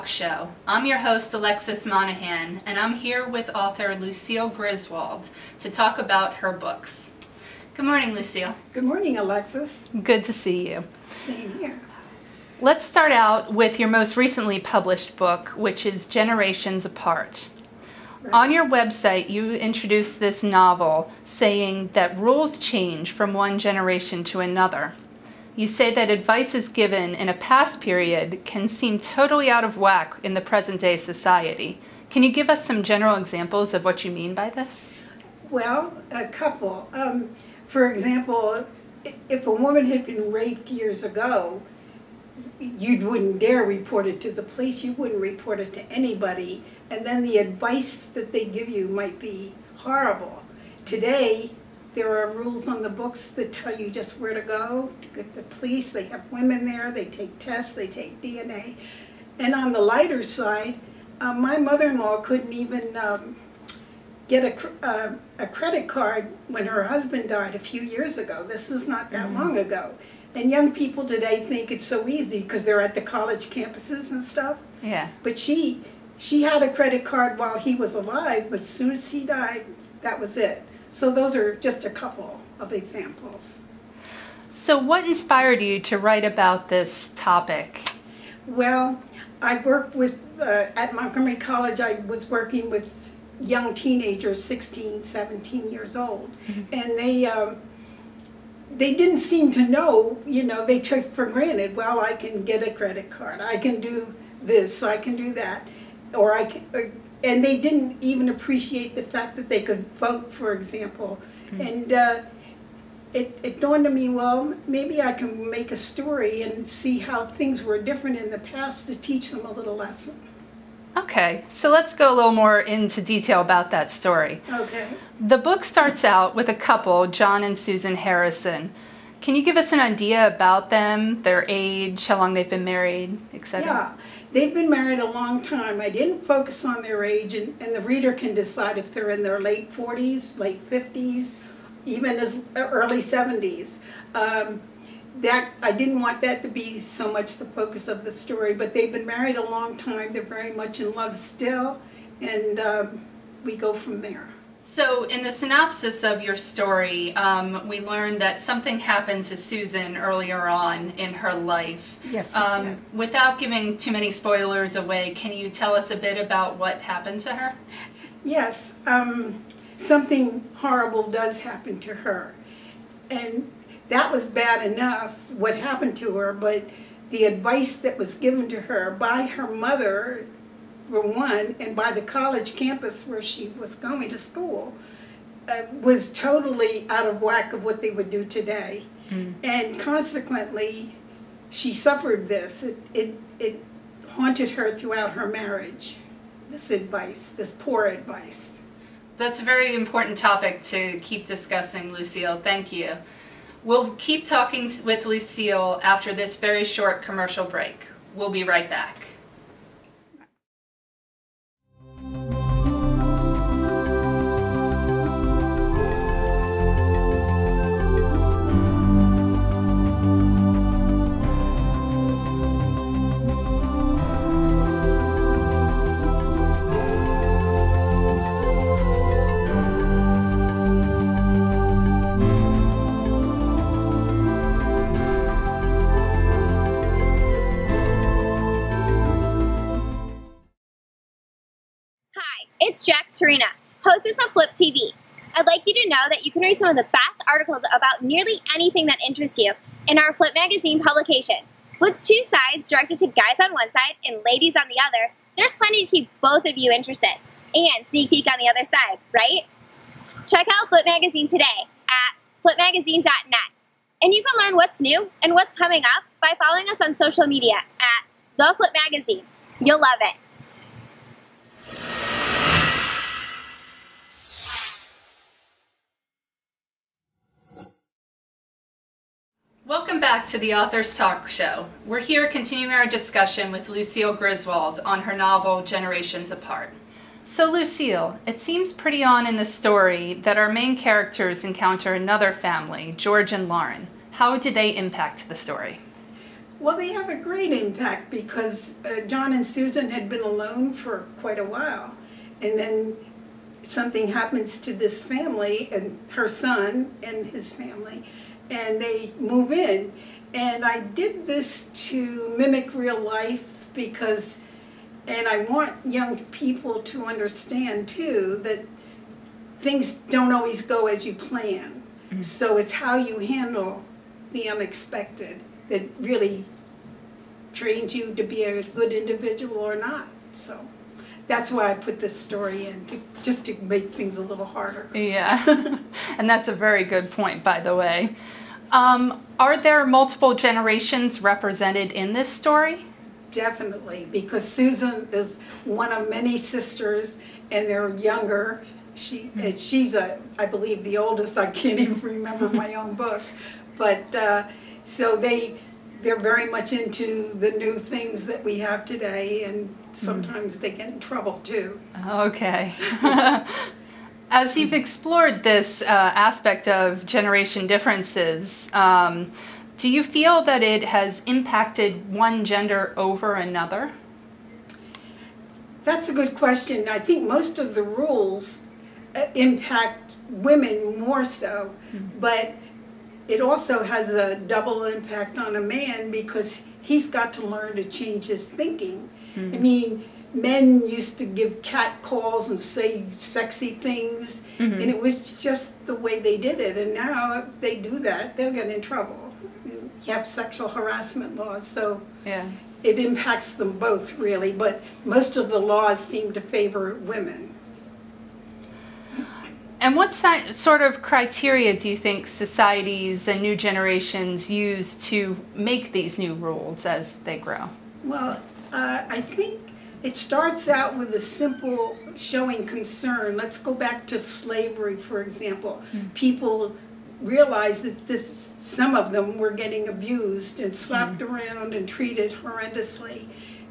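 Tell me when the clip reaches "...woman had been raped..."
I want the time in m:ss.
0:39.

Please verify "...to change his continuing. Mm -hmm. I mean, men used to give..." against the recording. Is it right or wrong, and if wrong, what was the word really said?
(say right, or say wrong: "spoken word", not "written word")
wrong: "thinking", not "continuing".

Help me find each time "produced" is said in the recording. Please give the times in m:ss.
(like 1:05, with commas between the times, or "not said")
not said.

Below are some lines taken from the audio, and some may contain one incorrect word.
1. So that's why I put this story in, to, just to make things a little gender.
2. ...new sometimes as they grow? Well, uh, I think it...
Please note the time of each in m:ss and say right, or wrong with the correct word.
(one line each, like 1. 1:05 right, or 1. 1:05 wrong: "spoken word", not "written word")
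1. 5:30 wrong: "harder", not "gender"
2. 6:56 wrong: "rules", not "sometimes".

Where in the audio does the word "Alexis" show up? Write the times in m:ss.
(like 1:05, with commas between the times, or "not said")
0:01, 0:09.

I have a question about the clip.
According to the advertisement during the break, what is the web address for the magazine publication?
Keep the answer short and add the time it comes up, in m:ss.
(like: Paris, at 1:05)
flipmagazine.net, at 4:22.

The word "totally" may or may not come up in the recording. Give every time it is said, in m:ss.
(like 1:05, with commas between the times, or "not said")
0:28, 3:06.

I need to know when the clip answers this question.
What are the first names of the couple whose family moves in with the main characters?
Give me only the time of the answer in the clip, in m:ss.
4:52.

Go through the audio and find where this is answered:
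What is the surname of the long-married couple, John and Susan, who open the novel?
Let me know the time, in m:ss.
2:07.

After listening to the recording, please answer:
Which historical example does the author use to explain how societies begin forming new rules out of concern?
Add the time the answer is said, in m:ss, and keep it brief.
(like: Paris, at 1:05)
Slavery, at 7:04.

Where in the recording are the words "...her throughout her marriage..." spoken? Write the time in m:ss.
3:14.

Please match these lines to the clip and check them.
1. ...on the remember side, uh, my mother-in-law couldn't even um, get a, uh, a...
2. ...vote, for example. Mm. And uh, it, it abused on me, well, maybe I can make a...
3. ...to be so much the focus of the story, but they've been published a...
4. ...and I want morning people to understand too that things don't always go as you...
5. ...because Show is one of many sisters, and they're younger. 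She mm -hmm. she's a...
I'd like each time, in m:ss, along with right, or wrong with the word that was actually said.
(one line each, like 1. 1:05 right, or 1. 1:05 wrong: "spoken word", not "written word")
1. 0:59 wrong: "lighter", not "remember"
2. 1:49 wrong: "dawned", not "abused"
3. 2:26 wrong: "married", not "published"
4. 5:15 wrong: "young", not "morning"
5. 5:44 wrong: "Susan", not "Show".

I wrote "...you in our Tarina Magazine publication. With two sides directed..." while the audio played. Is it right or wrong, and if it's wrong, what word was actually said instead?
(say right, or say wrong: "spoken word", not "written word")
wrong: "Flip", not "Tarina".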